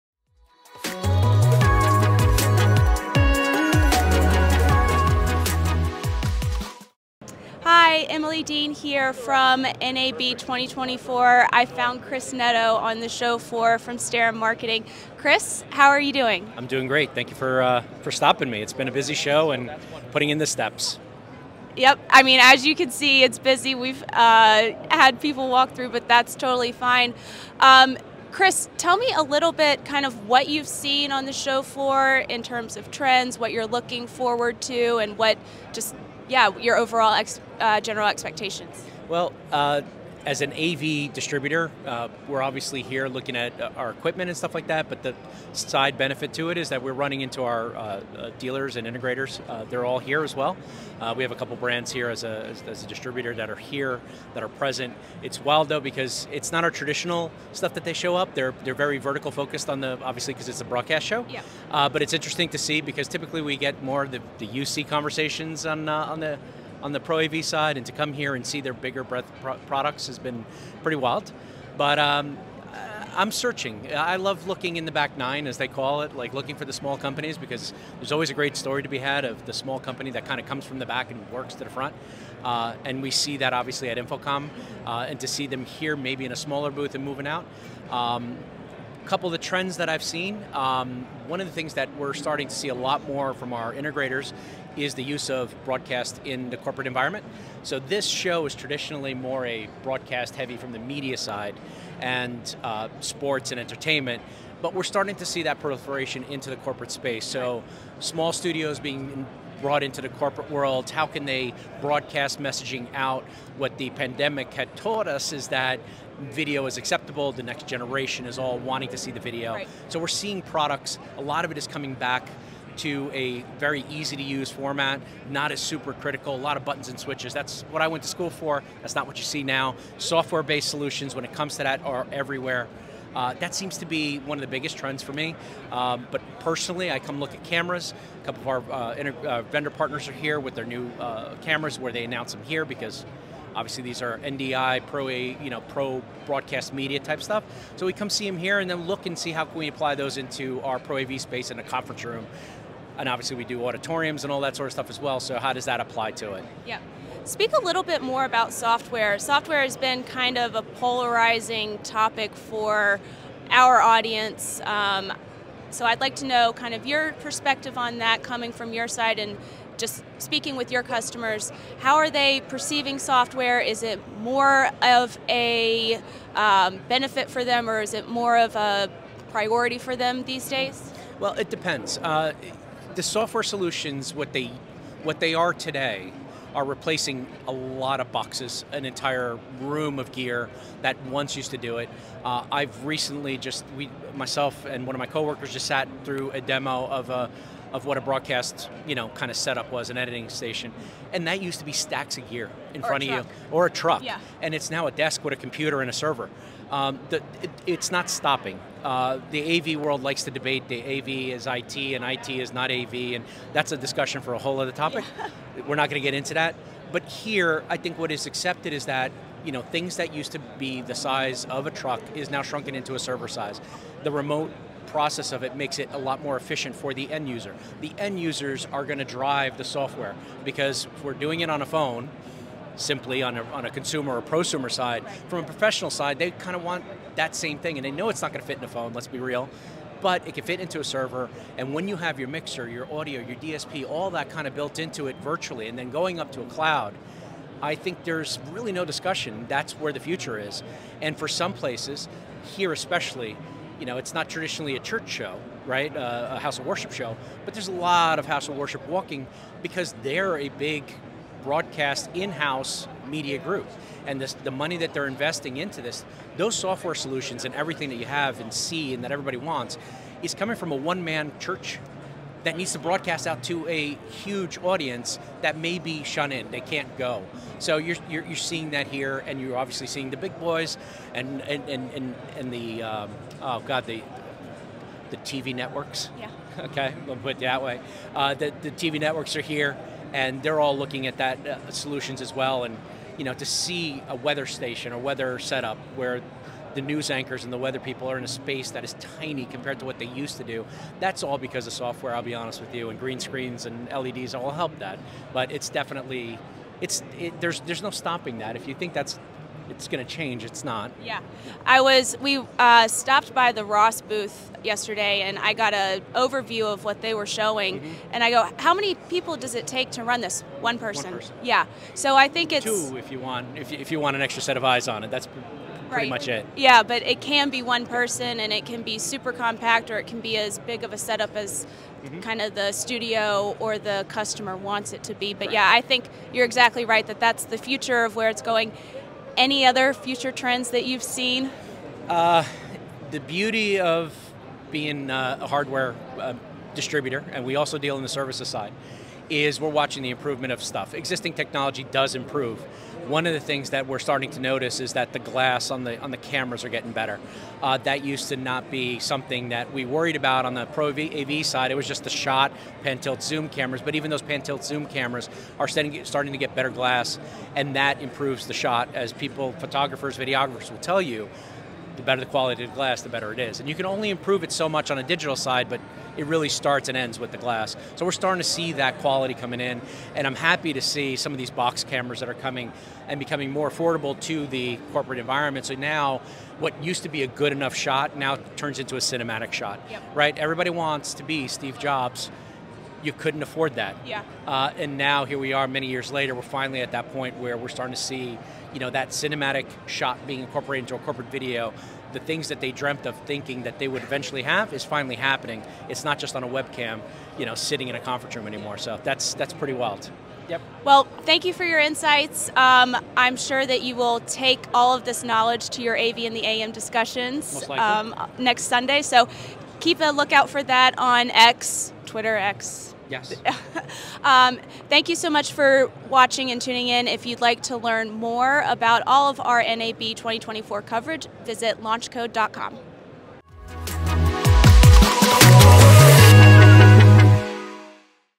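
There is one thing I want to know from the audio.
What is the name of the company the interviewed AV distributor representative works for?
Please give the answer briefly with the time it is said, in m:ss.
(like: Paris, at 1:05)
Starin Marketing, at 0:13.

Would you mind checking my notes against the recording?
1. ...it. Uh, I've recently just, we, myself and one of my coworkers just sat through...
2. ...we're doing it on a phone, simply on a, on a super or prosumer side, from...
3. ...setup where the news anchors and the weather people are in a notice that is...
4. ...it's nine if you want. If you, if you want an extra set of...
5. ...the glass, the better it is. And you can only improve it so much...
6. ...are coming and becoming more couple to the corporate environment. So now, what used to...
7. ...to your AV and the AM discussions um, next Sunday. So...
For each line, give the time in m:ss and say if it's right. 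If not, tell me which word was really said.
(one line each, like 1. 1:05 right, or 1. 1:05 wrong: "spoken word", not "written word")
1. 3:11 right
2. 3:51 wrong: "consumer", not "super"
3. 4:55 wrong: "space", not "notice"
4. 5:22 wrong: "two", not "nine"
5. 6:12 right
6. 6:22 wrong: "affordable", not "couple"
7. 6:55 right.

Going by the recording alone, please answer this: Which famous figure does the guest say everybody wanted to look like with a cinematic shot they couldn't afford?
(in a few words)
Steve Jobs.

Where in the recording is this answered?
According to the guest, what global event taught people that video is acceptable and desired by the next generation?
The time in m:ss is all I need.
1:53.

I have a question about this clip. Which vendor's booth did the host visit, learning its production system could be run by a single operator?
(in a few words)
Ross.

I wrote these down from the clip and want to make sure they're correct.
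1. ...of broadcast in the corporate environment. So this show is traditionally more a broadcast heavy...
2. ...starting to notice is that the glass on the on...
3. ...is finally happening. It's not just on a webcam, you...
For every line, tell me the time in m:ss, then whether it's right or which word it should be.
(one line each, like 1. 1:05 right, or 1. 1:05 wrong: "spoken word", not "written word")
1. 1:35 right
2. 5:53 right
3. 6:44 right.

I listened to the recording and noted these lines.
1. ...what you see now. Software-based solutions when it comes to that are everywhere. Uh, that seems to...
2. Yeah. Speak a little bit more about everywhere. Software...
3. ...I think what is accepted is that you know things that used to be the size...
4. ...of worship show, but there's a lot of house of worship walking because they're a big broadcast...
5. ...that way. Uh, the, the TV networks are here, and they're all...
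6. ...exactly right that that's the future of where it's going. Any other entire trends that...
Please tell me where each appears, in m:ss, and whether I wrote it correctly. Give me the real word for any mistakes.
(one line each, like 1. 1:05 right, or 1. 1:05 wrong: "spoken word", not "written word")
1. 2:09 right
2. 2:36 wrong: "software", not "everywhere"
3. 3:37 right
4. 4:16 right
5. 4:47 right
6. 5:36 wrong: "future", not "entire".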